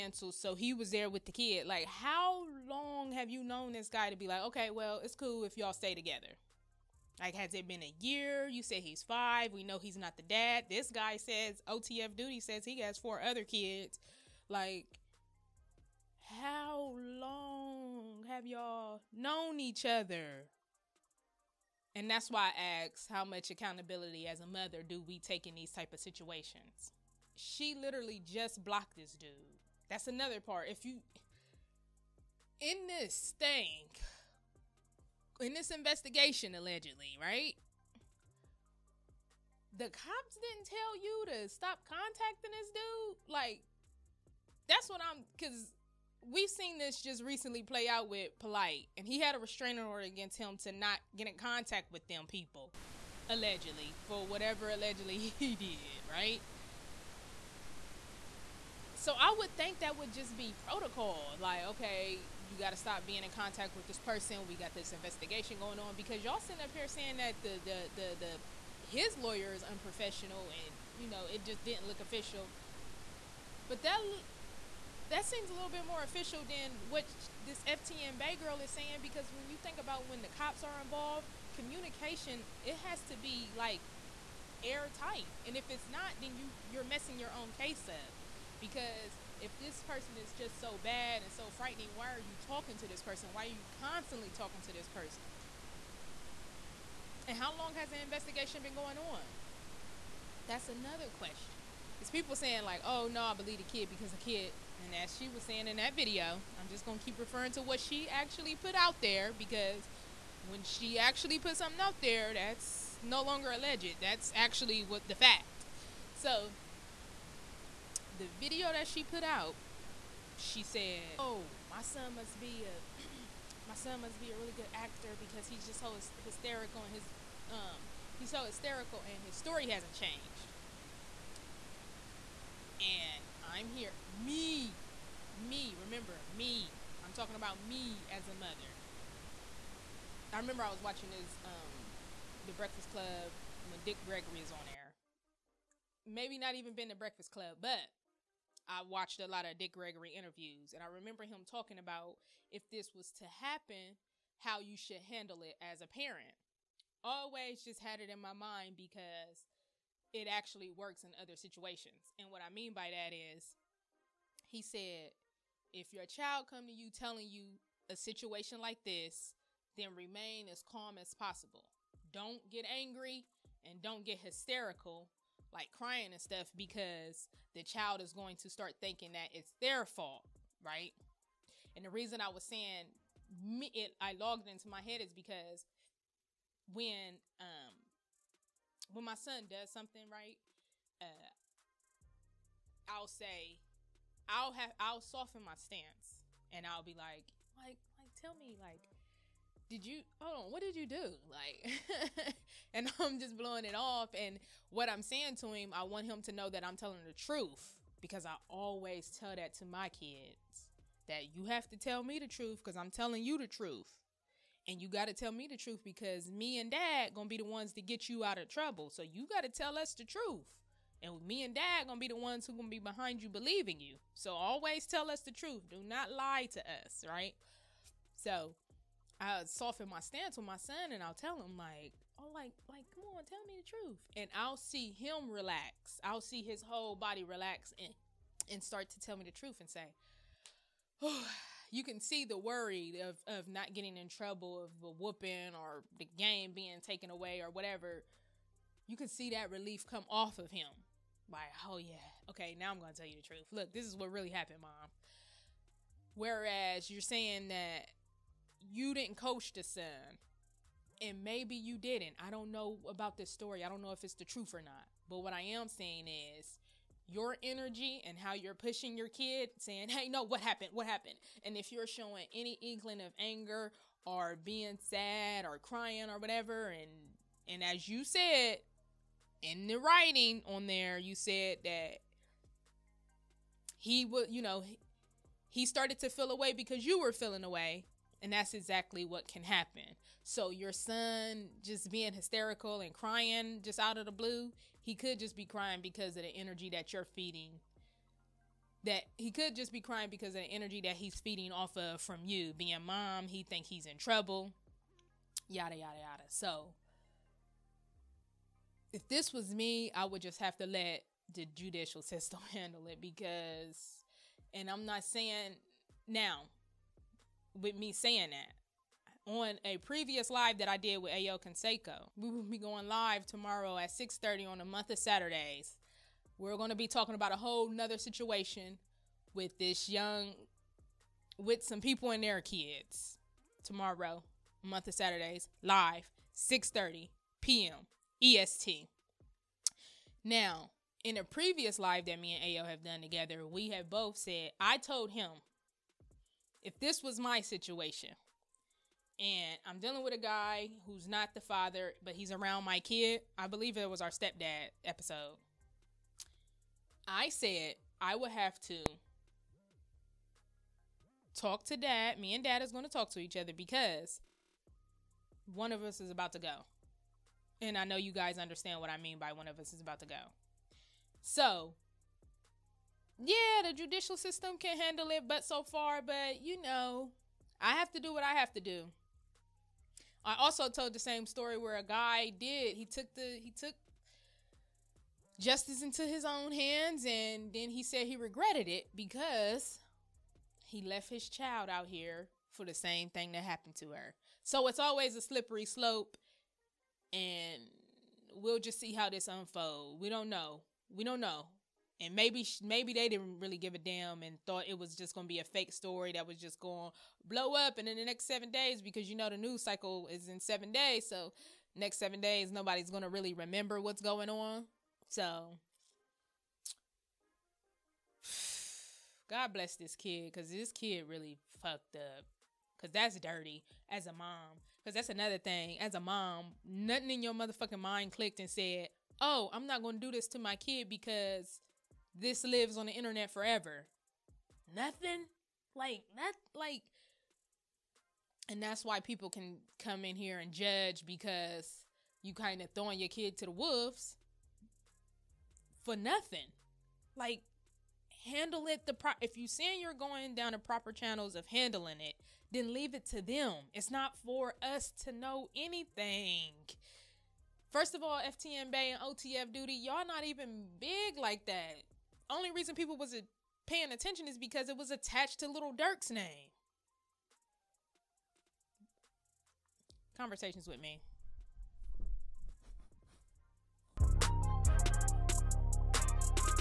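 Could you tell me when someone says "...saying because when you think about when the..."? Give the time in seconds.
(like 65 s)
78 s.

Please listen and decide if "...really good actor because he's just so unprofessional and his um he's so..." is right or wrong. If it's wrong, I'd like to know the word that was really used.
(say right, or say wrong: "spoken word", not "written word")
wrong: "hysterical", not "unprofessional".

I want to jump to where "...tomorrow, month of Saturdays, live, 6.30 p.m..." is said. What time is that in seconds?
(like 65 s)
333 s.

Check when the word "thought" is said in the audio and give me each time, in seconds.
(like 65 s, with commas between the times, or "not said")
404 s.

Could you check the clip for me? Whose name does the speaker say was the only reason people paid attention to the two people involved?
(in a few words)
Lil Durk.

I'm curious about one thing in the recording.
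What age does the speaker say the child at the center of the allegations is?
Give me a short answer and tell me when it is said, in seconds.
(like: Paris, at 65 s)
5, at 9 s.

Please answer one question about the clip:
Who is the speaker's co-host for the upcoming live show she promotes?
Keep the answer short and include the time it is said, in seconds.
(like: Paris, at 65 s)
Ayo Conseco, at 321 s.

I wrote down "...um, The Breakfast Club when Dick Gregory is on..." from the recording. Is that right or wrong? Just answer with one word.
right.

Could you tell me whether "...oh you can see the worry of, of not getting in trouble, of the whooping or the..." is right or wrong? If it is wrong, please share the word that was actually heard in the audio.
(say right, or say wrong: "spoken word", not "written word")
right.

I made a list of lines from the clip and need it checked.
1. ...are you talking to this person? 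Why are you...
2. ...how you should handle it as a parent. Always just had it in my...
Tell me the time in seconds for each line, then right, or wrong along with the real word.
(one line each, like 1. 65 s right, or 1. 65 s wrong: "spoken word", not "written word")
1. 92 s right
2. 154 s right.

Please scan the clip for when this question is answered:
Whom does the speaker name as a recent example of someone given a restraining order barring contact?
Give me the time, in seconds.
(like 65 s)
48 s.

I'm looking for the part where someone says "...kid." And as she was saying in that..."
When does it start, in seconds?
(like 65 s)
104 s.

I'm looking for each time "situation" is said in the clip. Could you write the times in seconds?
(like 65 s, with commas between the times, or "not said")
25 s, 161 s, 167 s, 327 s, 347 s.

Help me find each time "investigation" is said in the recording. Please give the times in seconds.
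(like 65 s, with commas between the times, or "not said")
35 s, 64 s, 98 s.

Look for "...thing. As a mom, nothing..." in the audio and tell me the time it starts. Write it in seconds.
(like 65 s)
425 s.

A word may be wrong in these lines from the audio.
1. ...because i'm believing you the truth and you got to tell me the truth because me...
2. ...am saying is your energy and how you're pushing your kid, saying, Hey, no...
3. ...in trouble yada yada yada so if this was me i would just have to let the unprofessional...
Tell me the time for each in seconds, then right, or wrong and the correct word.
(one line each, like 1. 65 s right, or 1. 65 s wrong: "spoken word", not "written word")
1. 212 s wrong: "telling", not "believing"
2. 265 s right
3. 303 s wrong: "judicial", not "unprofessional".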